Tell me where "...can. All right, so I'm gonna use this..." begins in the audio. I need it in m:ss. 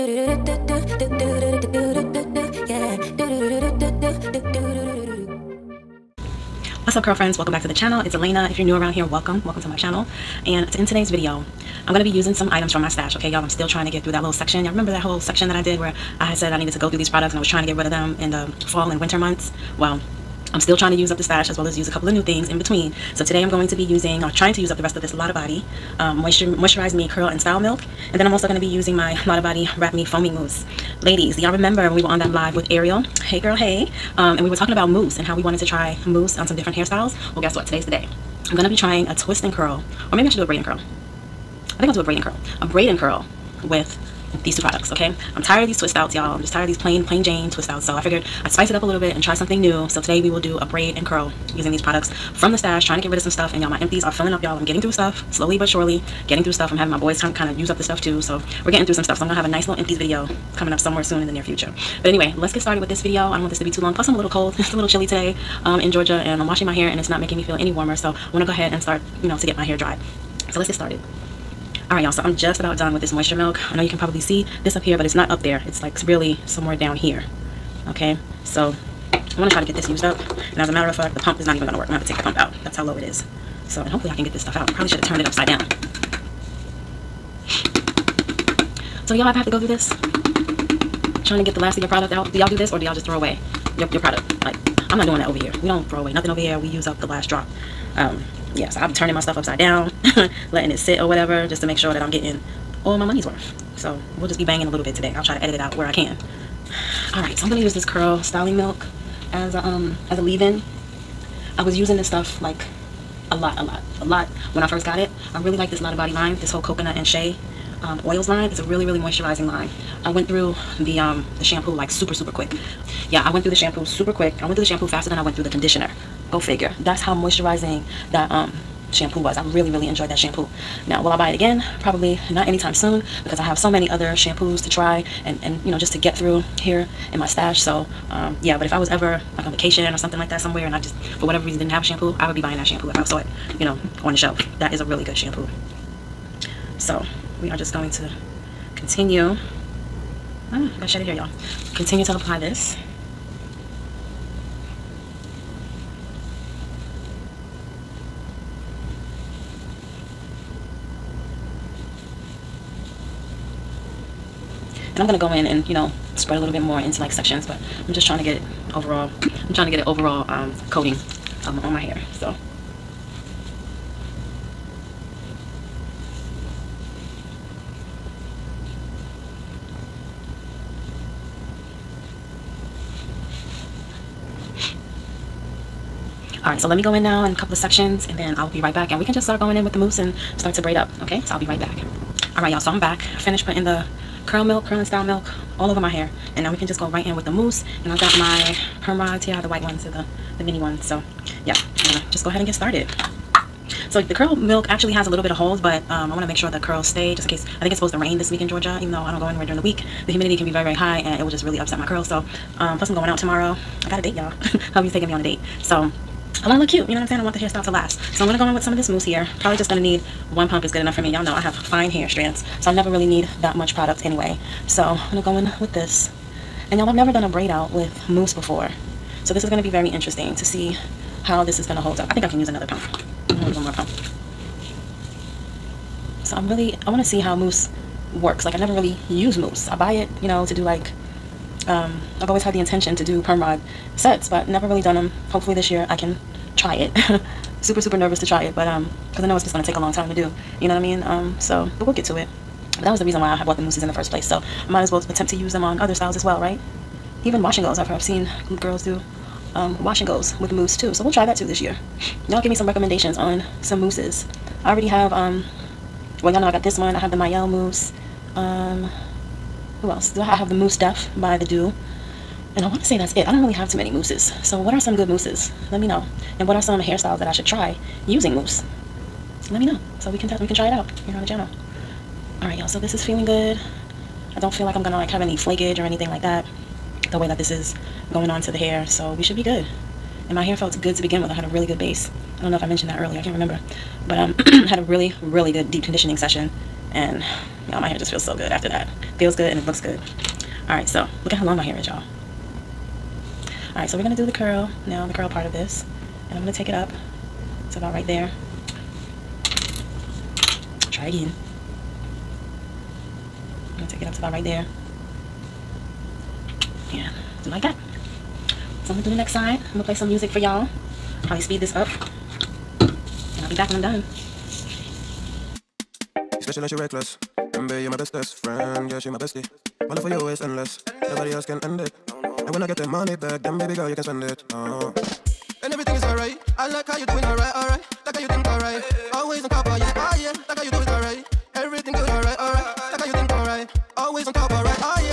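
1:45.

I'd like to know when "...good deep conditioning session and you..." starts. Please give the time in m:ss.
4:55.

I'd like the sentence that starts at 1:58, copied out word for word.
It's a really, really moisturizing line.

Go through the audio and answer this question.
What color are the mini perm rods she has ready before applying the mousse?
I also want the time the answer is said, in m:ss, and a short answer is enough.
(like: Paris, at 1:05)
white, at 3:19.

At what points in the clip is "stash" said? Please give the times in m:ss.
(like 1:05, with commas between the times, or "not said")
0:12, 0:21, 0:52, 2:17.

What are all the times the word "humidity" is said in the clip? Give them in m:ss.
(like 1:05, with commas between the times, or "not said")
3:30.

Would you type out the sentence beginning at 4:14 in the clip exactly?
So I might as well attempt to use them on other styles as well, right?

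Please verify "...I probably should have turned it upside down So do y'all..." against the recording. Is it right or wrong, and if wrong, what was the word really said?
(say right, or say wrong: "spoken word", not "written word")
right.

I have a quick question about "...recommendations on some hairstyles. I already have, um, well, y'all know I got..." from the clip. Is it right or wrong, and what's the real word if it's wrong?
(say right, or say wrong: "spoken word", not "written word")
wrong: "mousses", not "hairstyles".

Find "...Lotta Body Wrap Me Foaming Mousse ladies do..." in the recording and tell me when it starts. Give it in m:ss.
0:29.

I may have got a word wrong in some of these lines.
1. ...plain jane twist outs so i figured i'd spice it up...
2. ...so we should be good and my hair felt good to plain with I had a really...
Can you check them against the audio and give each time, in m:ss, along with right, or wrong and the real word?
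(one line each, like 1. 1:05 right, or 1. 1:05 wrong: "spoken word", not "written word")
1. 0:47 right
2. 4:48 wrong: "begin", not "plain".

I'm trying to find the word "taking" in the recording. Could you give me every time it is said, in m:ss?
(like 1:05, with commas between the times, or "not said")
3:34.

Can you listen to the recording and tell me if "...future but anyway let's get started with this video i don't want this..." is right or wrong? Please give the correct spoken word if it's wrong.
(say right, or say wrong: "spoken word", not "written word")
right.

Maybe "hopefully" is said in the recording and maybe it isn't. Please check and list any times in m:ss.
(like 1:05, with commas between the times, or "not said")
1:23, 4:05.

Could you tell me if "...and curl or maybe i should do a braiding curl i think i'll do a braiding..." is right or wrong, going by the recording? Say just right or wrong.
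right.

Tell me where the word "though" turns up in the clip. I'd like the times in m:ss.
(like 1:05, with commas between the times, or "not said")
3:28.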